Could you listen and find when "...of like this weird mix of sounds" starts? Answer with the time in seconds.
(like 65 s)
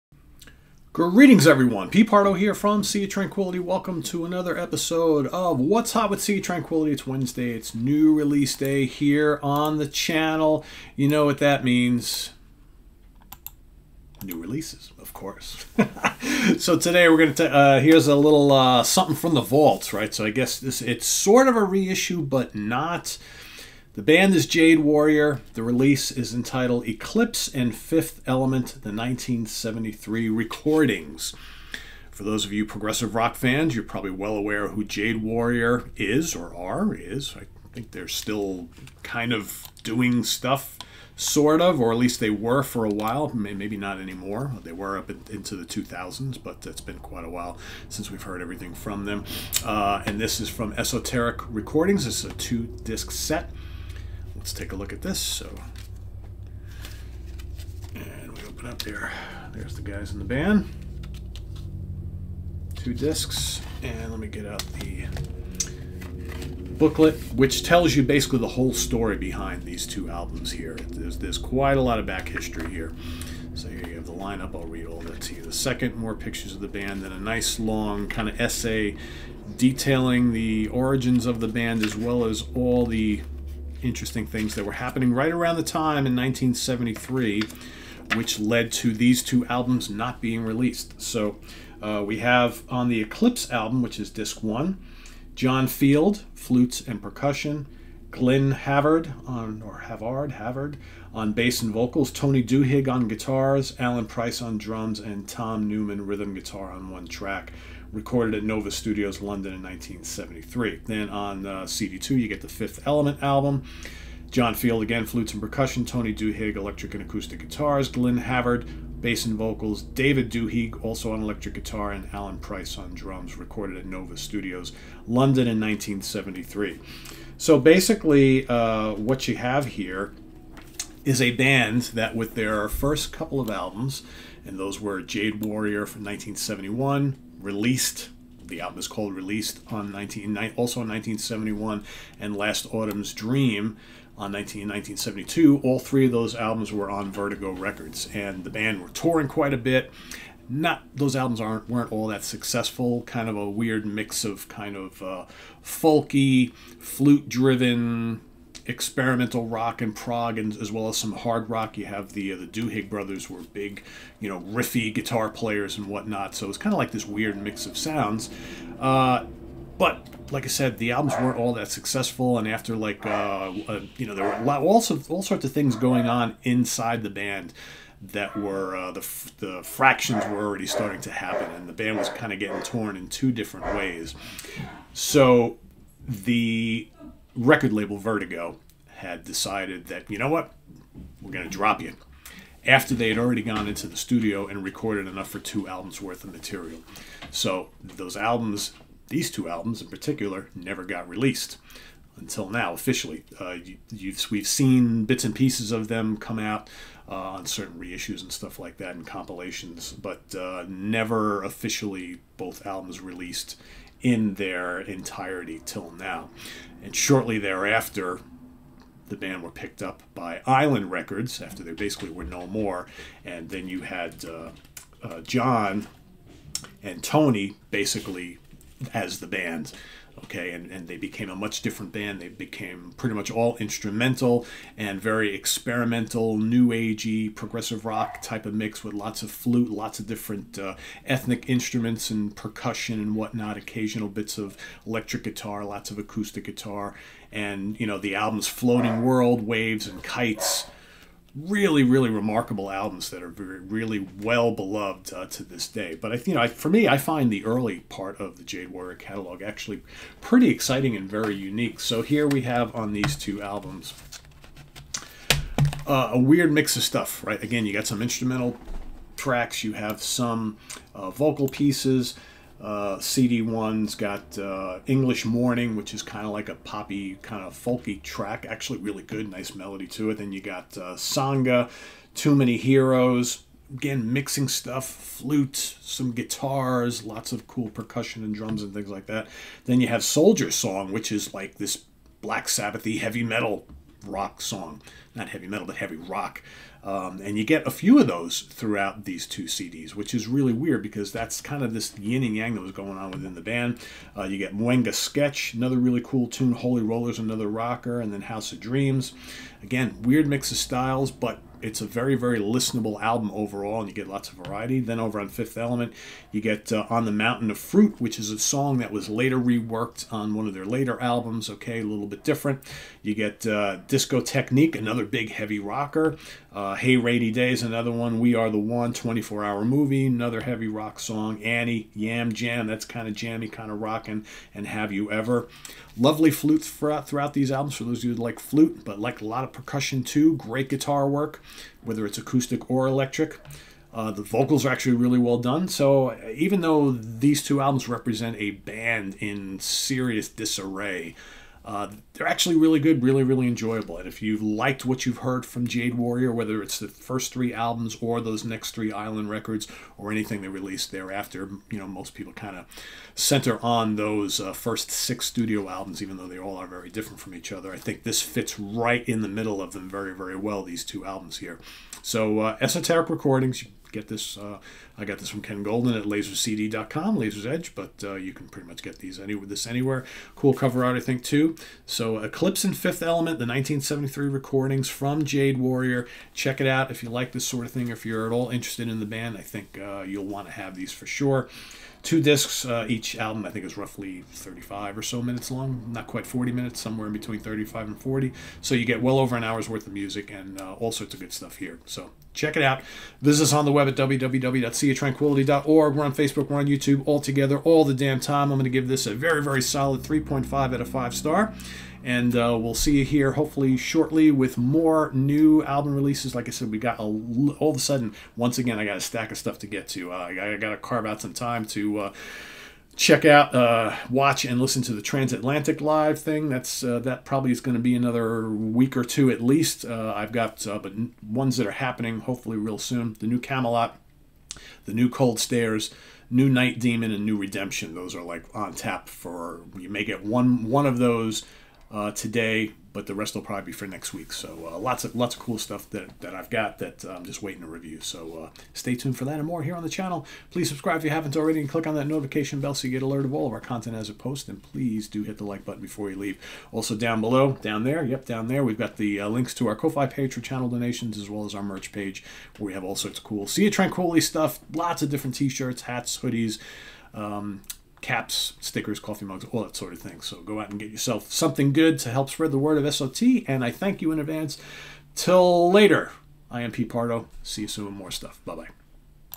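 166 s.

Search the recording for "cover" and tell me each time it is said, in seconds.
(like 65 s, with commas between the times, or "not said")
380 s.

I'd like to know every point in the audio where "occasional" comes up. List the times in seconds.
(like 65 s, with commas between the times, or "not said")
243 s.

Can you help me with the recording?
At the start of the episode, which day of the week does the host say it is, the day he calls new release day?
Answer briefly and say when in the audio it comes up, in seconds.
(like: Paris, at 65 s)
Wednesday, at 7 s.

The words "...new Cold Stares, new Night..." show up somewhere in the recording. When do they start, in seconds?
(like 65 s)
434 s.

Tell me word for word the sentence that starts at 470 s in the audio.
So go out and get yourself something good to help spread the word of SOT.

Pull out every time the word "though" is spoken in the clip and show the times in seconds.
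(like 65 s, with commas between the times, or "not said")
346 s, 366 s.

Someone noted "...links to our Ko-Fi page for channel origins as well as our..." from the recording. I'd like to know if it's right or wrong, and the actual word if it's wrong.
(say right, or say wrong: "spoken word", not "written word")
wrong: "donations", not "origins".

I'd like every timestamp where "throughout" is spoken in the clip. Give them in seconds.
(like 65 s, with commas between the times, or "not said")
298 s, 336 s.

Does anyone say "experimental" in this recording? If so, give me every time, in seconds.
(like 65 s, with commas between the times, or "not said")
158 s, 235 s.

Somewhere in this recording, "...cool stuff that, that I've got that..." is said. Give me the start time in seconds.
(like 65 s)
445 s.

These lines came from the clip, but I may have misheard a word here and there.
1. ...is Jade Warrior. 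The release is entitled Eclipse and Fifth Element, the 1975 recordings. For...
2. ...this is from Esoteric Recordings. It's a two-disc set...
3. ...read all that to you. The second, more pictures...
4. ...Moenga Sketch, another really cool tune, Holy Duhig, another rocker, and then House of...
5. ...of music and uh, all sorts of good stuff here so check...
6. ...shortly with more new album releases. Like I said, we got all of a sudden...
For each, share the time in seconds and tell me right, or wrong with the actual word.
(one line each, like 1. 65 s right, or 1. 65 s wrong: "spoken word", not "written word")
1. 24 s wrong: "1973", not "1975"
2. 50 s right
3. 74 s right
4. 304 s wrong: "Rollers", not "Duhig"
5. 399 s right
6. 413 s right.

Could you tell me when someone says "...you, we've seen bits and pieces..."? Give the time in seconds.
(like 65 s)
203 s.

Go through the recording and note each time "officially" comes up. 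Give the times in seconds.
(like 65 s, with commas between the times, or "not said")
202 s, 211 s.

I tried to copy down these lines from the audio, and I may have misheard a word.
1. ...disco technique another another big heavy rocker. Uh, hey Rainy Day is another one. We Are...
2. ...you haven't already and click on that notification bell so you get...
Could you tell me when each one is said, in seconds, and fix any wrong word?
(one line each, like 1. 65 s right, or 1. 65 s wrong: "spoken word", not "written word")
1. 323 s right
2. 451 s right.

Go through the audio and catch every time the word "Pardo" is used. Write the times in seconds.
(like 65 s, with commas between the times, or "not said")
2 s, 476 s.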